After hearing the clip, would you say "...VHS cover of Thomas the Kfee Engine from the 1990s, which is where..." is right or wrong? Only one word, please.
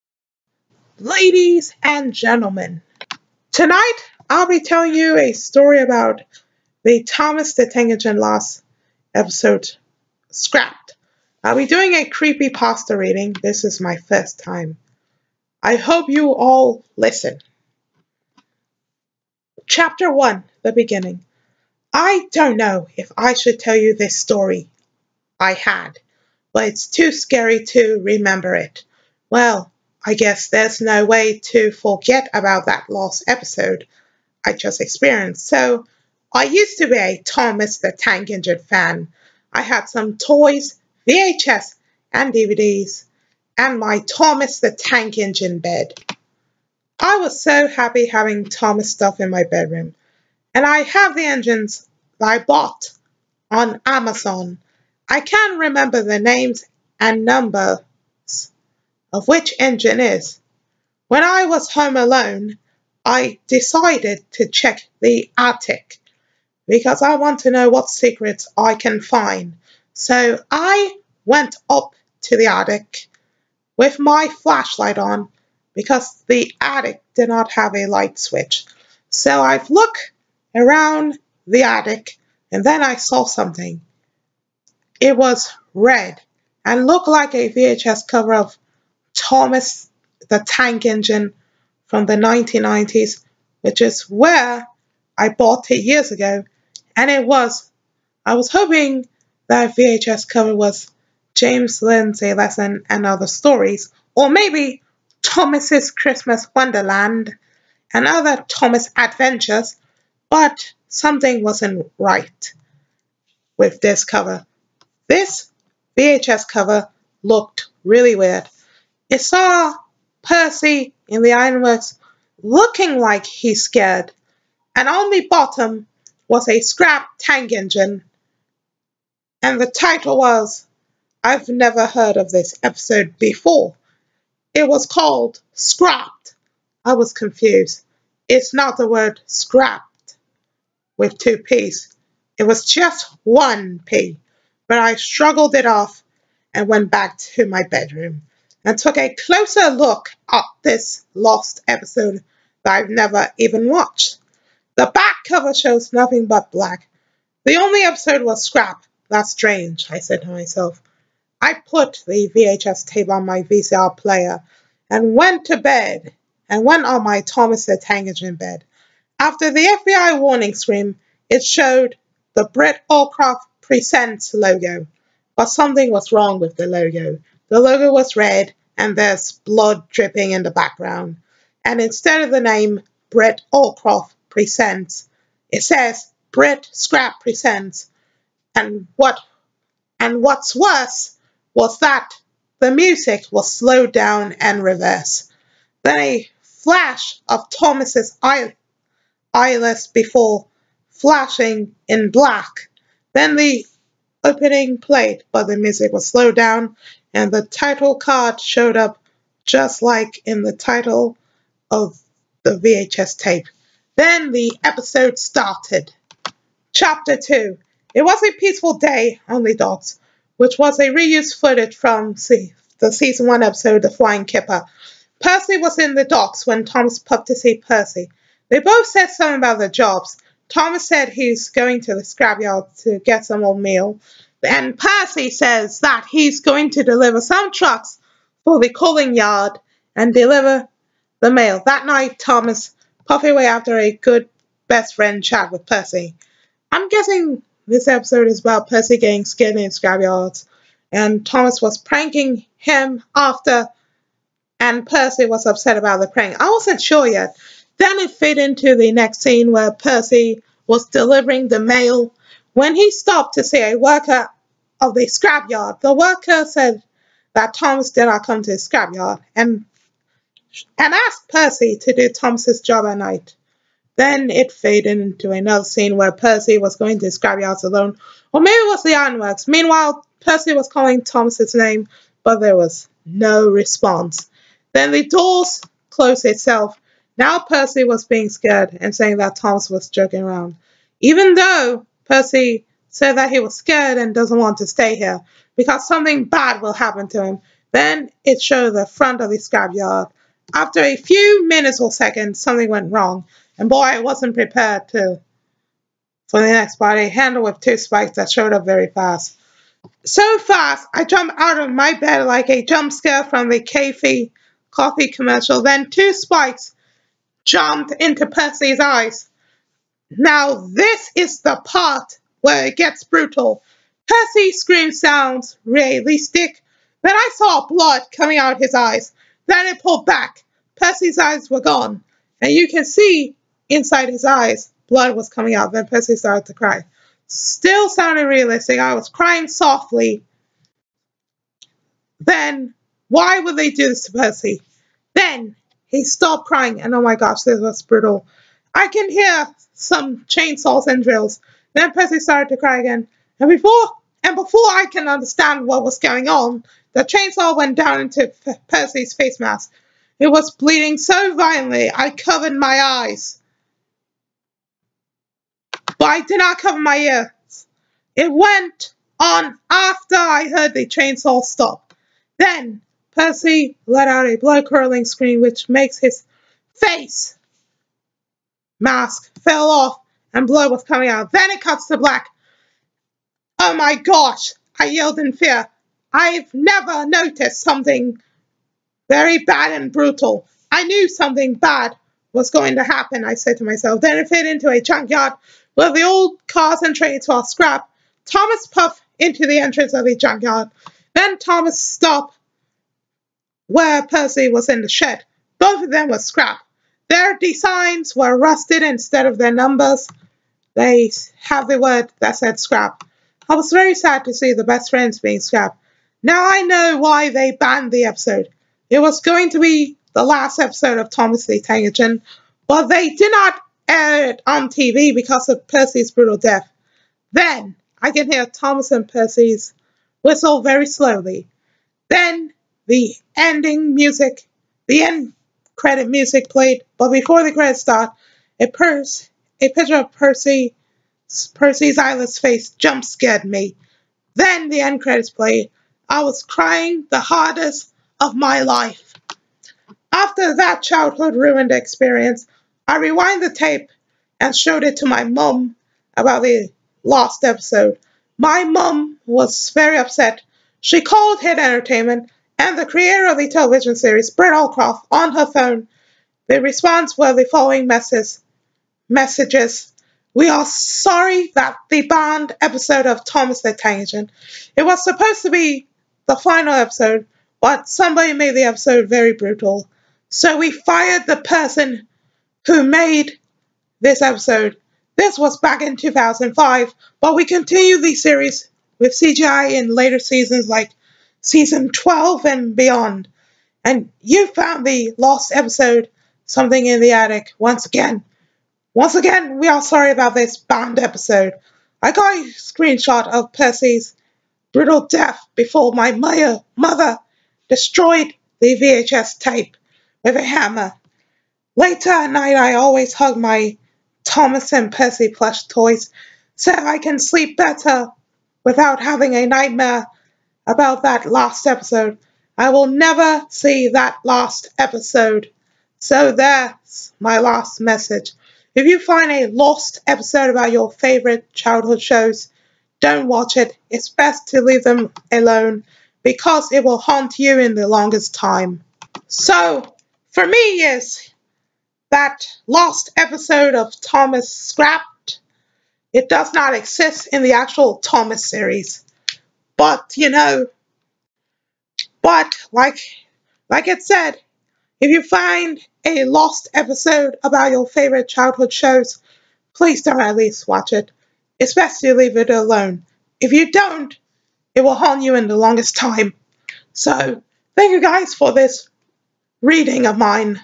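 wrong.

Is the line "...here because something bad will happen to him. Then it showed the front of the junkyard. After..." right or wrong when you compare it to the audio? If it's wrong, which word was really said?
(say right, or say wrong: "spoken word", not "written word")
wrong: "scrapyard", not "junkyard".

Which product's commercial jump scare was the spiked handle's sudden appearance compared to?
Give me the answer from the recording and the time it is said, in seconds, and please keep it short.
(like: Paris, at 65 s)
K-fee coffee, at 313 s.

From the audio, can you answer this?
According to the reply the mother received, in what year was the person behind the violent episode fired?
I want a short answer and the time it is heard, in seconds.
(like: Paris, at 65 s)
2005, at 485 s.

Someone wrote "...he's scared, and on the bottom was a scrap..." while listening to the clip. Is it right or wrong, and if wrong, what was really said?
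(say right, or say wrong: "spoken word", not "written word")
right.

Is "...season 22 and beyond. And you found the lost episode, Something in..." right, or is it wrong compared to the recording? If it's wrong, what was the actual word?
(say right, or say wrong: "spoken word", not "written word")
wrong: "12", not "22".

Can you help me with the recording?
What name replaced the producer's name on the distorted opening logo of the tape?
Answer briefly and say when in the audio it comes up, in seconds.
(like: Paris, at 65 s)
Brett Scrap Presents, at 186 s.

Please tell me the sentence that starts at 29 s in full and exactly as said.
Well, I guess there's no way to forget about that last episode I just experienced.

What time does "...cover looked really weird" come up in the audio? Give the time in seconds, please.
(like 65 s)
116 s.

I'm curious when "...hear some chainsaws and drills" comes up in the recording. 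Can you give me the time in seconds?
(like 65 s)
349 s.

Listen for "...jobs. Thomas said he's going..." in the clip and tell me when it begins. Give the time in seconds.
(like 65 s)
229 s.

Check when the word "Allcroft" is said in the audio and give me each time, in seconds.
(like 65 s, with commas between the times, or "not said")
172 s, 183 s, 464 s.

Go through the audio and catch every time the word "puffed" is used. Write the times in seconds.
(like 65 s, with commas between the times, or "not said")
243 s, 398 s.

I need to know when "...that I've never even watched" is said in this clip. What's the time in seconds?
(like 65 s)
152 s.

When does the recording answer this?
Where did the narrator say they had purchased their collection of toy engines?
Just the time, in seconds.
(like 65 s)
53 s.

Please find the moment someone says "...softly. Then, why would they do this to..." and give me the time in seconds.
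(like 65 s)
339 s.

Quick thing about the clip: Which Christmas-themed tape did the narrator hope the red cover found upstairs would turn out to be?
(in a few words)
Thomas's Christmas Wonderland.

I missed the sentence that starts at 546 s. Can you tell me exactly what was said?
It does not exist in the actual Thomas series.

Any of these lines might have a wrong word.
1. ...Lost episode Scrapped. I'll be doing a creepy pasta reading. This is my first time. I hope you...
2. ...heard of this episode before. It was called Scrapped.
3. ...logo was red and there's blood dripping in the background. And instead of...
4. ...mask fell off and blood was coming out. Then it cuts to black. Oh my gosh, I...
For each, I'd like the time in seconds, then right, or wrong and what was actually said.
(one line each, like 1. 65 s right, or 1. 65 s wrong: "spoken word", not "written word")
1. 8 s right
2. 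131 s right
3. 177 s right
4. 378 s right.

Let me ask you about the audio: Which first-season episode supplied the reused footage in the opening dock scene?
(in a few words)
The Flying Kipper.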